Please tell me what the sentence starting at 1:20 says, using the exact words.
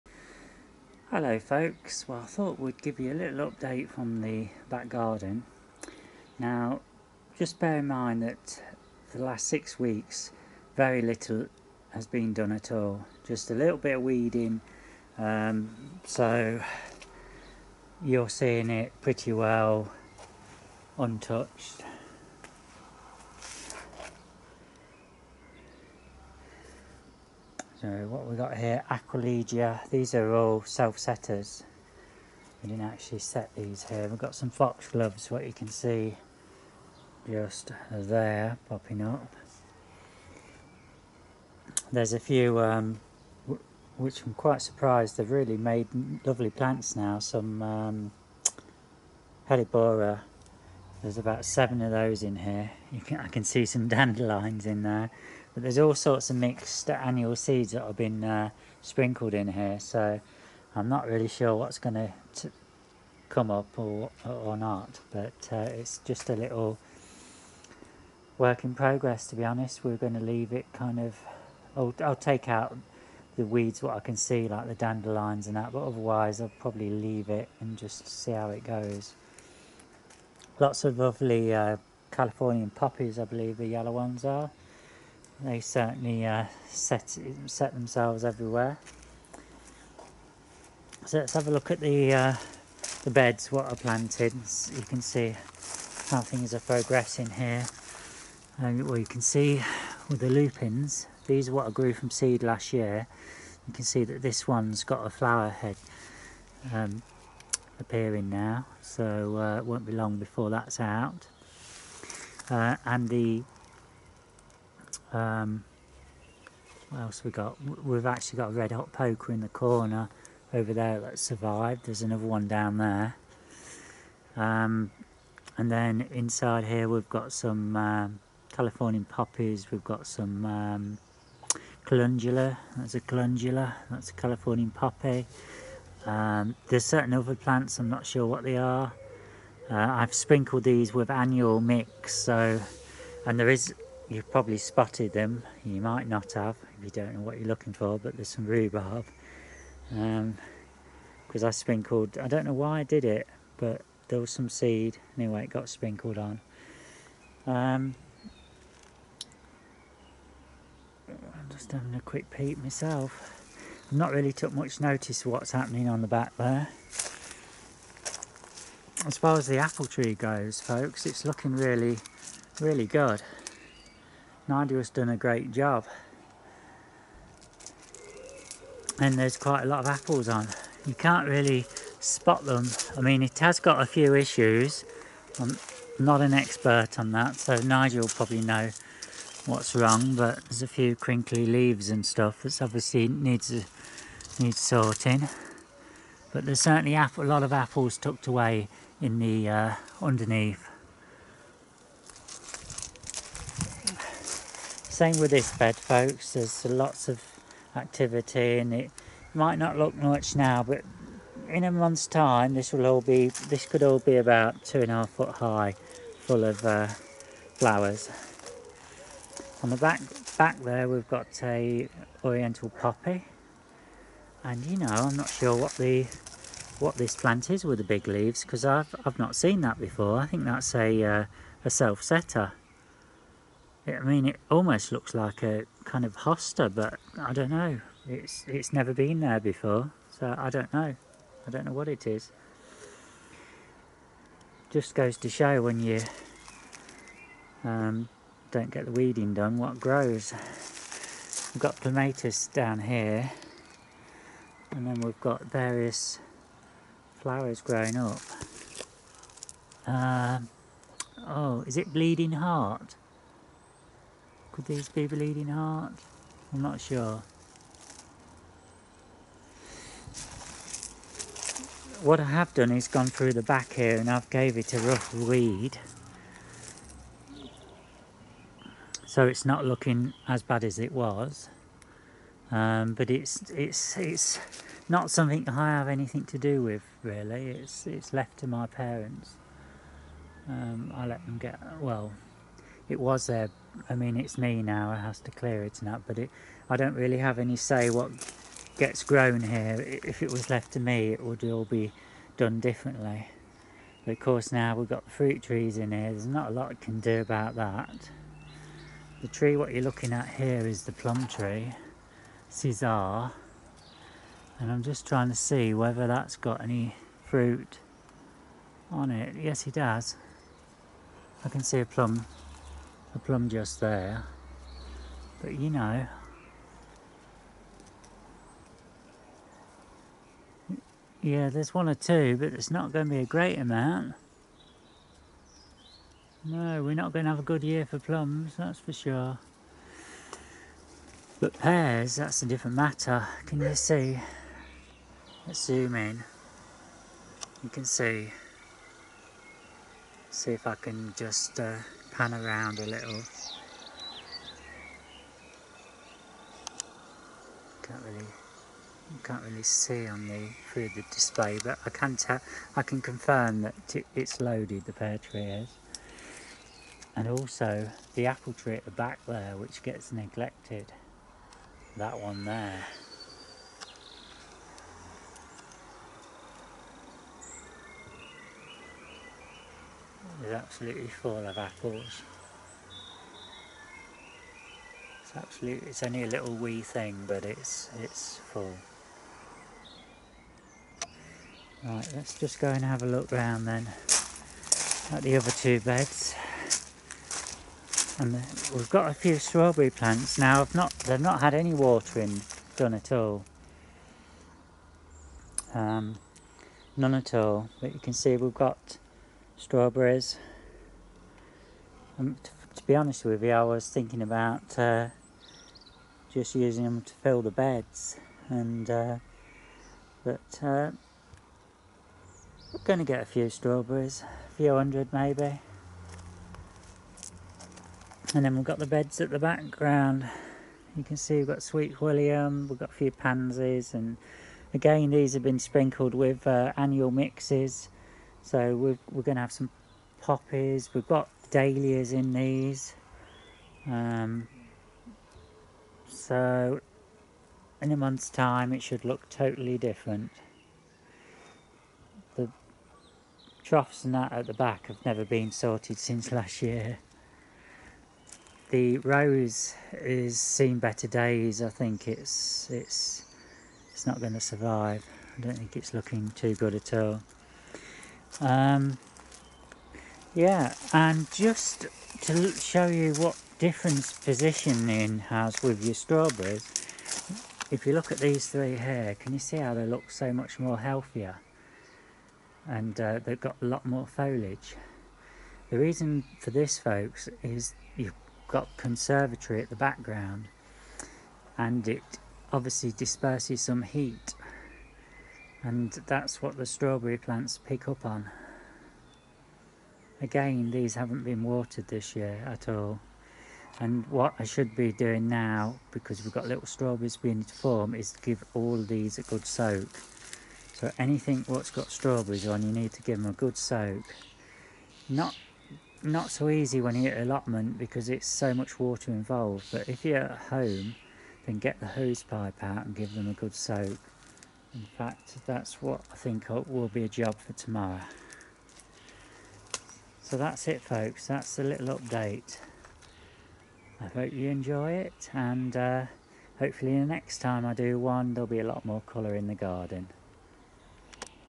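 Lots of lovely uh, Californian poppies I believe the yellow ones are they certainly uh, set set themselves everywhere.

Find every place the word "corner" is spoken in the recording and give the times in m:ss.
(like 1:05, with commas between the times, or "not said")
1:59.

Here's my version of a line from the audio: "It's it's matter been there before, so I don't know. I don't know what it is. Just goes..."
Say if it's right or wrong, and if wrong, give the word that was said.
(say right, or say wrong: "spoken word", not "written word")
wrong: "never", not "matter".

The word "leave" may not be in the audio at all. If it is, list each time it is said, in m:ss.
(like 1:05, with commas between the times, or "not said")
1:10, 1:16, 3:11, 3:48.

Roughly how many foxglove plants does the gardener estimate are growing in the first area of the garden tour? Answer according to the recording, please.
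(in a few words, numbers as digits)
7.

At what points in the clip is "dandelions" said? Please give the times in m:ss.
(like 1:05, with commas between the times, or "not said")
0:53, 1:14.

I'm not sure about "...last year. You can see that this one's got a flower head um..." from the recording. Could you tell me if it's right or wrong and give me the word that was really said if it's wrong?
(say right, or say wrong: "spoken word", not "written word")
right.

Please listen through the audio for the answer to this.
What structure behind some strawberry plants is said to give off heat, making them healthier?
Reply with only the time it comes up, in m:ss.
8:08.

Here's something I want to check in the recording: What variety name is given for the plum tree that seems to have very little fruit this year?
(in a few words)
Czar.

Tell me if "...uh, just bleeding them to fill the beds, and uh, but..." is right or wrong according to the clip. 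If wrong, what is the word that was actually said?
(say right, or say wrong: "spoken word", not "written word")
wrong: "using", not "bleeding".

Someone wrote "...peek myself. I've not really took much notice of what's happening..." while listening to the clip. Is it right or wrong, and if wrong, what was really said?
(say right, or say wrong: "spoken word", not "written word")
right.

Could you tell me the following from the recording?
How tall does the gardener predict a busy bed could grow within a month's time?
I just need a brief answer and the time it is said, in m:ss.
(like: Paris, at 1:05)
Two and a half foot, at 3:34.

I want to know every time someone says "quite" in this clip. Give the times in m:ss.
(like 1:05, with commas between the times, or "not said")
0:44, 2:59.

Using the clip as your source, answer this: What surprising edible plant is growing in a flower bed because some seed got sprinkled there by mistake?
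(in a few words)
Rhubarb.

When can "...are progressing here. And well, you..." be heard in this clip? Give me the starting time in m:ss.
1:36.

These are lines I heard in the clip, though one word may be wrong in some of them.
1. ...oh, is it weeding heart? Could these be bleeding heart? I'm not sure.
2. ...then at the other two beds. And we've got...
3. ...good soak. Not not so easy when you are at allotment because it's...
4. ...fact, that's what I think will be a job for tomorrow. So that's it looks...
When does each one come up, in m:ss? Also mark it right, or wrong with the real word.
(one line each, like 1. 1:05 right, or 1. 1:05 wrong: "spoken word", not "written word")
1. 4:21 wrong: "bleeding", not "weeding"
2. 6:33 right
3. 8:33 right
4. 8:44 wrong: "folks", not "looks".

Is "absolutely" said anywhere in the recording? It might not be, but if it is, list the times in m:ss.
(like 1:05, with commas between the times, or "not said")
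6:20, 6:25.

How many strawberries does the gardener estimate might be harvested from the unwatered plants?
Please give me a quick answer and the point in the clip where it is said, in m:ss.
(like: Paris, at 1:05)
A few hundred, at 7:04.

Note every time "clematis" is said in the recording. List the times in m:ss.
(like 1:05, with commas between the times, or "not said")
4:11.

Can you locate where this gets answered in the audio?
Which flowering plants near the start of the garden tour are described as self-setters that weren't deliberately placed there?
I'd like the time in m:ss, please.
0:28.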